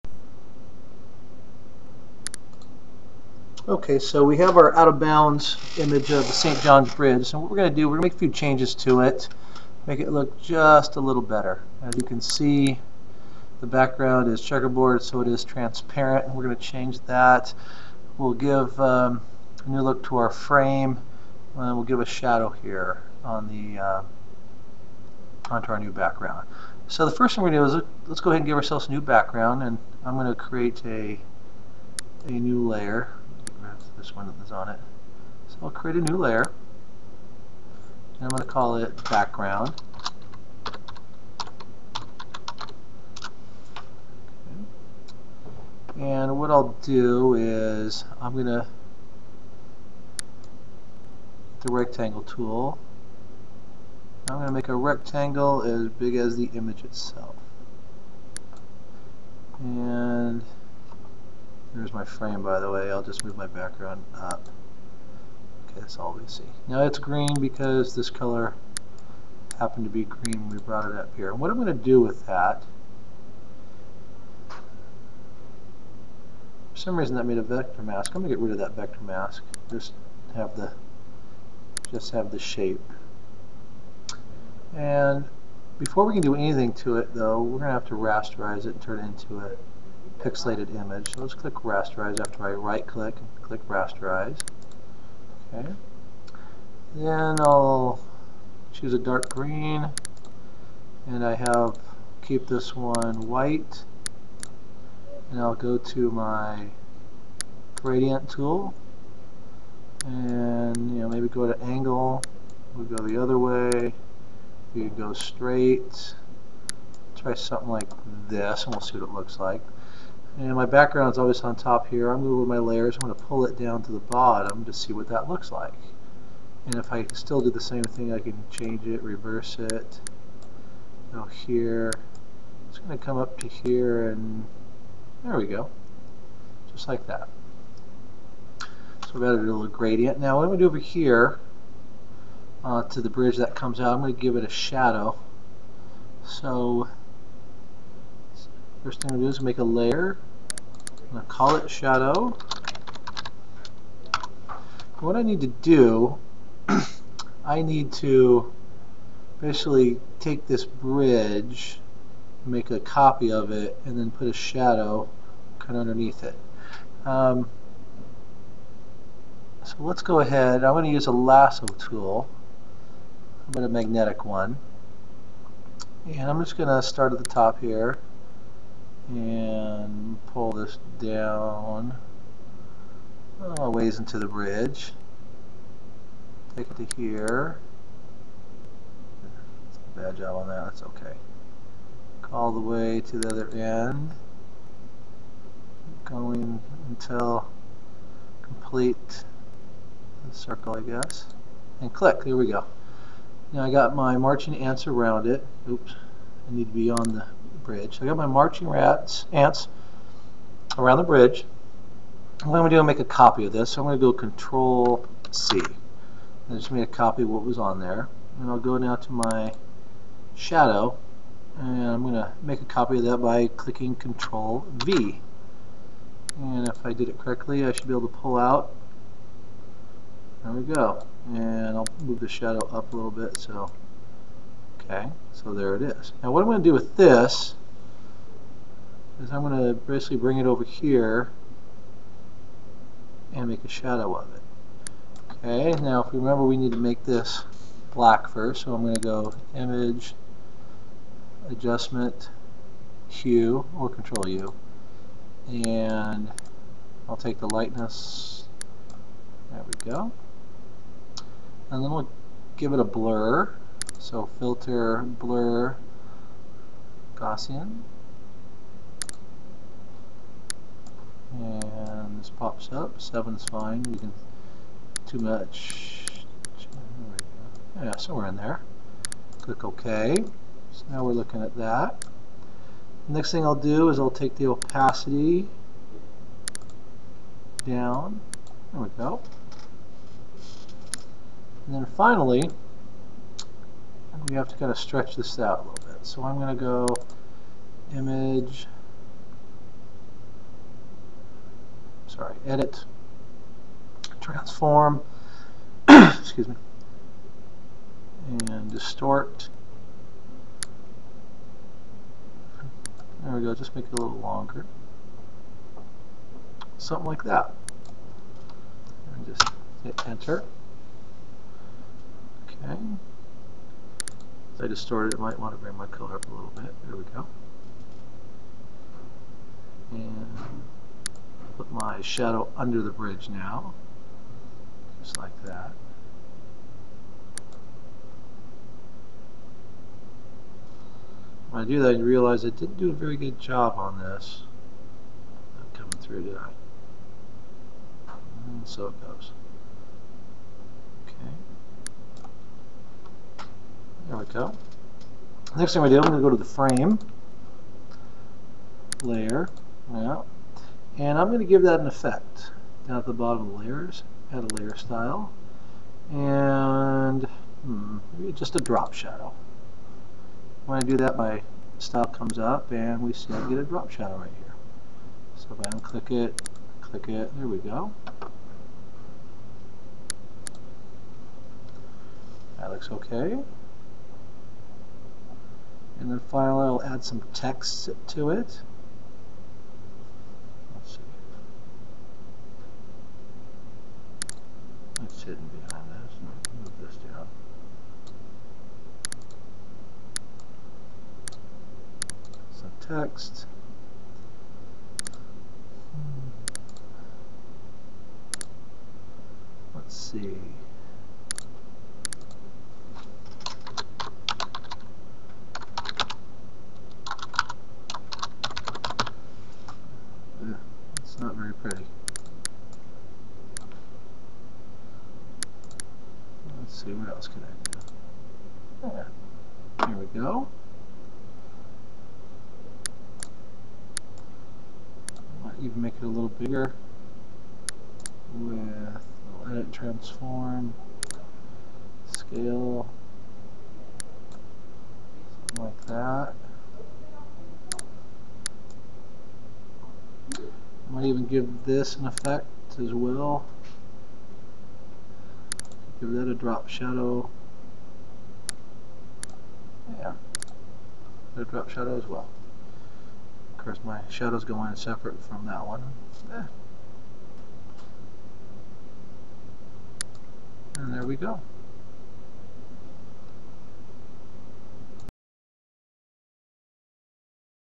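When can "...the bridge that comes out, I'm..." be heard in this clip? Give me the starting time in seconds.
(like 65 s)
143 s.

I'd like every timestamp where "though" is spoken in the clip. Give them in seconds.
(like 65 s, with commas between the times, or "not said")
87 s.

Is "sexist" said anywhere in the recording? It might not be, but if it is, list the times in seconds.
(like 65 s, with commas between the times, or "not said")
not said.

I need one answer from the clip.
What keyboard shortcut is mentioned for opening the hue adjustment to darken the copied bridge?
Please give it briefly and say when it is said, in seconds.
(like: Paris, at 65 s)
Control U, at 253 s.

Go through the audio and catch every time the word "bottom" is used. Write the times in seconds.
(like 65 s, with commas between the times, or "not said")
123 s, 363 s.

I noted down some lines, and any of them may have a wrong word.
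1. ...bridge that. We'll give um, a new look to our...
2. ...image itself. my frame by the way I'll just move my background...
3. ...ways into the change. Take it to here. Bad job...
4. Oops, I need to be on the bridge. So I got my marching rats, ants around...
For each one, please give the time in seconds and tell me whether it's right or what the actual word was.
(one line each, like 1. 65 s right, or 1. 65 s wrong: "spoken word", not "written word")
1. 16 s wrong: "change", not "bridge"
2. 56 s right
3. 183 s wrong: "bridge", not "change"
4. 205 s right.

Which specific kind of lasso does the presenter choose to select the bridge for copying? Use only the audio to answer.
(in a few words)
magnetic.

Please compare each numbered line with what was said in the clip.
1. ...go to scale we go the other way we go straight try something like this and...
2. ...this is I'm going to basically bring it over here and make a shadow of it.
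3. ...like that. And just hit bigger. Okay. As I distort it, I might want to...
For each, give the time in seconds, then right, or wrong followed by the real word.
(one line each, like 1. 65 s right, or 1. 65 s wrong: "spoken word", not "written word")
1. 111 s wrong: "angle", not "scale"
2. 236 s right
3. 317 s wrong: "enter", not "bigger".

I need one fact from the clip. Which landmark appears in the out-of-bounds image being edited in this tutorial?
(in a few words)
St. John's Bridge.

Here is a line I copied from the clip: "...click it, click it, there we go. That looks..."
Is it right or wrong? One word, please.
wrong.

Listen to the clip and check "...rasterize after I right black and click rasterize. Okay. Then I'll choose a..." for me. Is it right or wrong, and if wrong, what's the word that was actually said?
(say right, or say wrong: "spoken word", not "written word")
wrong: "click", not "black".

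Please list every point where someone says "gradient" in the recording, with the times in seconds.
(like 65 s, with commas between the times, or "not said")
107 s, 139 s.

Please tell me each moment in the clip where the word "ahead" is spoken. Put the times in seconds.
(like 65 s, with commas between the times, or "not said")
28 s, 170 s.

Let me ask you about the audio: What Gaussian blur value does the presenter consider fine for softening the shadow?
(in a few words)
7.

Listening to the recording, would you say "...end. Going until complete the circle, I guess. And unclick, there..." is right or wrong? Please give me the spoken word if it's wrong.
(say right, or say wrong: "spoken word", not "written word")
wrong: "click", not "unclick".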